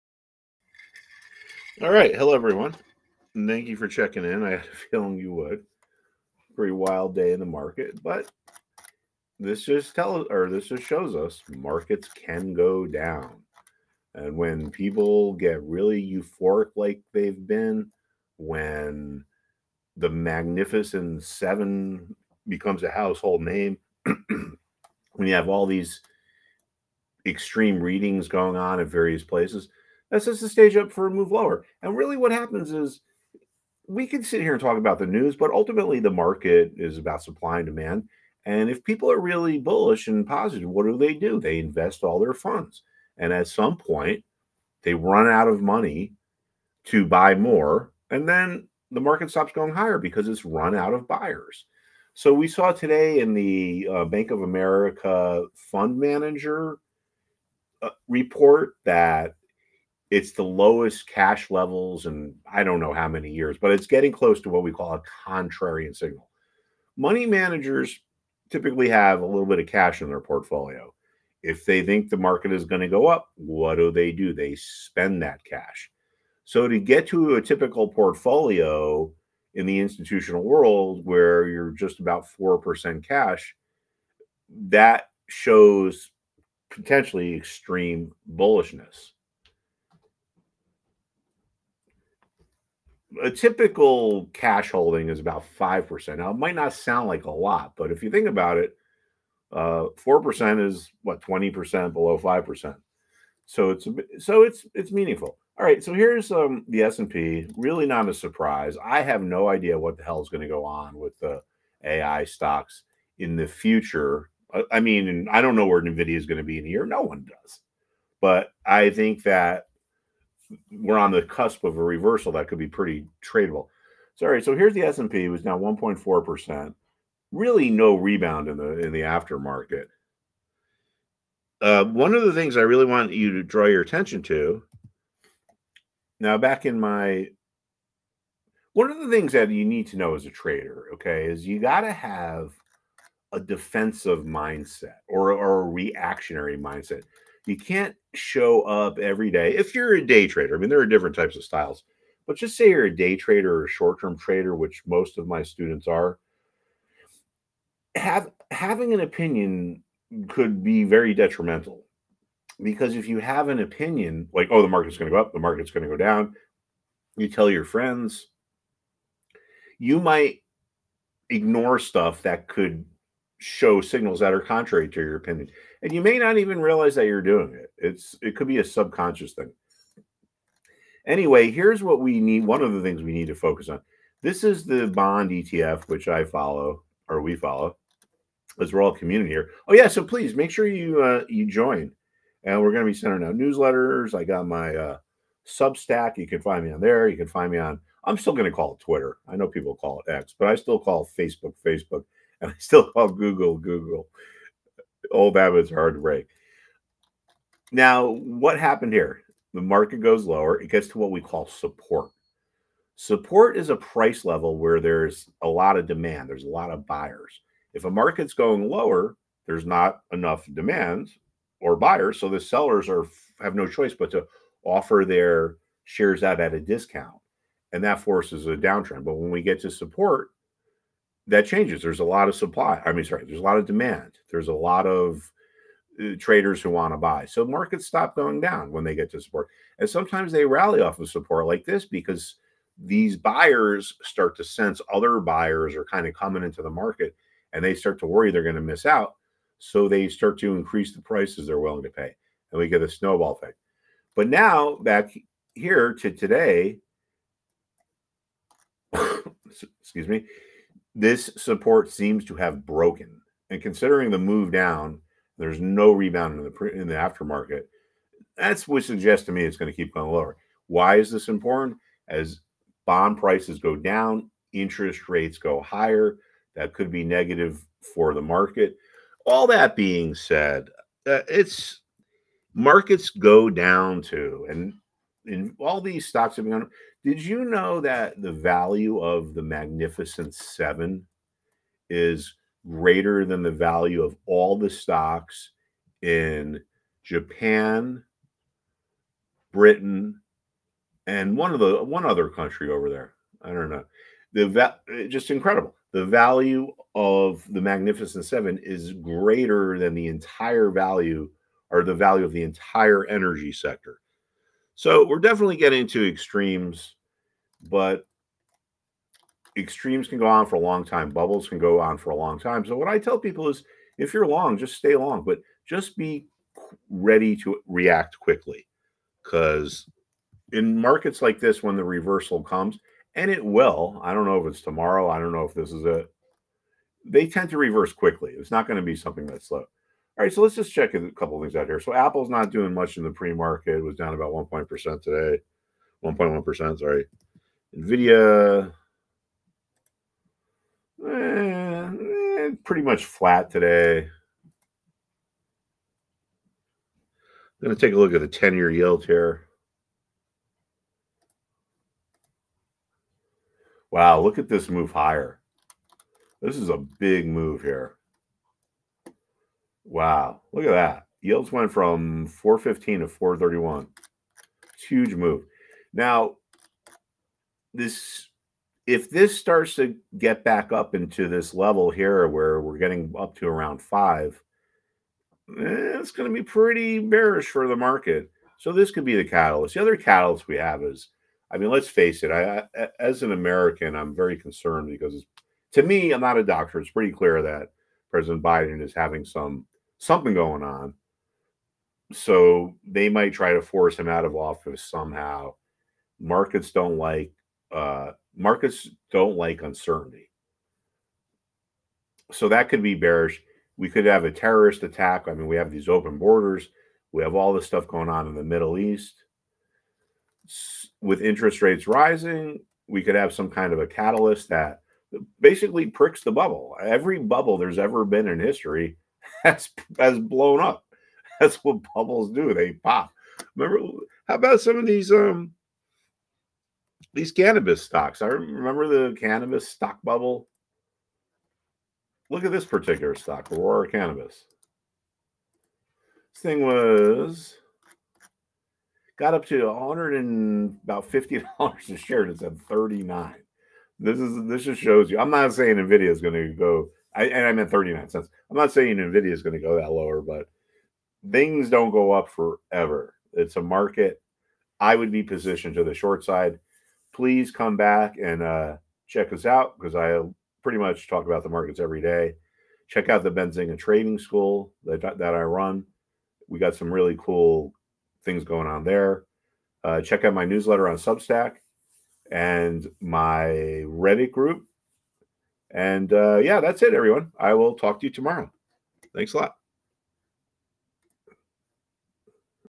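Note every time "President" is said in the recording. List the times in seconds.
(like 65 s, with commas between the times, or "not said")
398 s.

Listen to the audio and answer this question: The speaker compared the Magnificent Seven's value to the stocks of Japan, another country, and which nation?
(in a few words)
Britain.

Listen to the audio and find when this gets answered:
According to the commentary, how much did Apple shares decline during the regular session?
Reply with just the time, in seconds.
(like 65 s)
346 s.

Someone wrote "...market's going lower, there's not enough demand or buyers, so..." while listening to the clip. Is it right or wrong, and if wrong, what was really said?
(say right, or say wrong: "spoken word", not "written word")
right.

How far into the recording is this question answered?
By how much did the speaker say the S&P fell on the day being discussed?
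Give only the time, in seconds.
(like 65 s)
125 s.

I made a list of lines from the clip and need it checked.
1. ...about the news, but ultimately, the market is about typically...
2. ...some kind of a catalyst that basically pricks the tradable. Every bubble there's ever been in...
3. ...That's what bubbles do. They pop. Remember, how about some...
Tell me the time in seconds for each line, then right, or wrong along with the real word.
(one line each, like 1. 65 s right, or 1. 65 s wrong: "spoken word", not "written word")
1. 34 s wrong: "supply", not "typically"
2. 423 s wrong: "bubble", not "tradable"
3. 431 s right.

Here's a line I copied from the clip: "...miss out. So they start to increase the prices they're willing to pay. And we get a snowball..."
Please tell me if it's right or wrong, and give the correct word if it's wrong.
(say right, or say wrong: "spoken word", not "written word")
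right.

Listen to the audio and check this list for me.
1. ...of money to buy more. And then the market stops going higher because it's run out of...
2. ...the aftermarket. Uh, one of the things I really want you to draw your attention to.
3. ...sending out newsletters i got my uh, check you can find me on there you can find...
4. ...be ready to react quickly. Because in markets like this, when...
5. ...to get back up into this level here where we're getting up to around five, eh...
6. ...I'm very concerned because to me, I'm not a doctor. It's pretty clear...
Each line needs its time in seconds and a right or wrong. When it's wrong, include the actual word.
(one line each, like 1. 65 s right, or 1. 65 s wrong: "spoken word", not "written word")
1. 45 s right
2. 128 s right
3. 192 s wrong: "substack", not "check"
4. 325 s right
5. 379 s right
6. 393 s right.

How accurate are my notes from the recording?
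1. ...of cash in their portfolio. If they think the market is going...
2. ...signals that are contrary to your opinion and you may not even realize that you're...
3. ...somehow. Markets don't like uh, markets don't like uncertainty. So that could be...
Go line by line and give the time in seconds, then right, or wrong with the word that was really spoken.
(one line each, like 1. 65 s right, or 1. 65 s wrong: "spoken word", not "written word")
1. 69 s right
2. 173 s right
3. 404 s right.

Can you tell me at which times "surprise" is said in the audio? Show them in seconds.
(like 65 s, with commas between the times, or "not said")
108 s.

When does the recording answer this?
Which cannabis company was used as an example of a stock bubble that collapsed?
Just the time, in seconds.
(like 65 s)
443 s.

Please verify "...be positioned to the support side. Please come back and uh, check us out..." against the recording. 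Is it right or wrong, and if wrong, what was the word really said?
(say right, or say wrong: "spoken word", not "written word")
wrong: "short", not "support".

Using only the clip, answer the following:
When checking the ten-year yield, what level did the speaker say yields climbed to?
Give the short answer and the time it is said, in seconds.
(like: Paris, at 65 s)
4.31, at 373 s.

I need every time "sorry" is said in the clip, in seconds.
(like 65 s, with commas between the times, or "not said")
124 s, 233 s, 346 s.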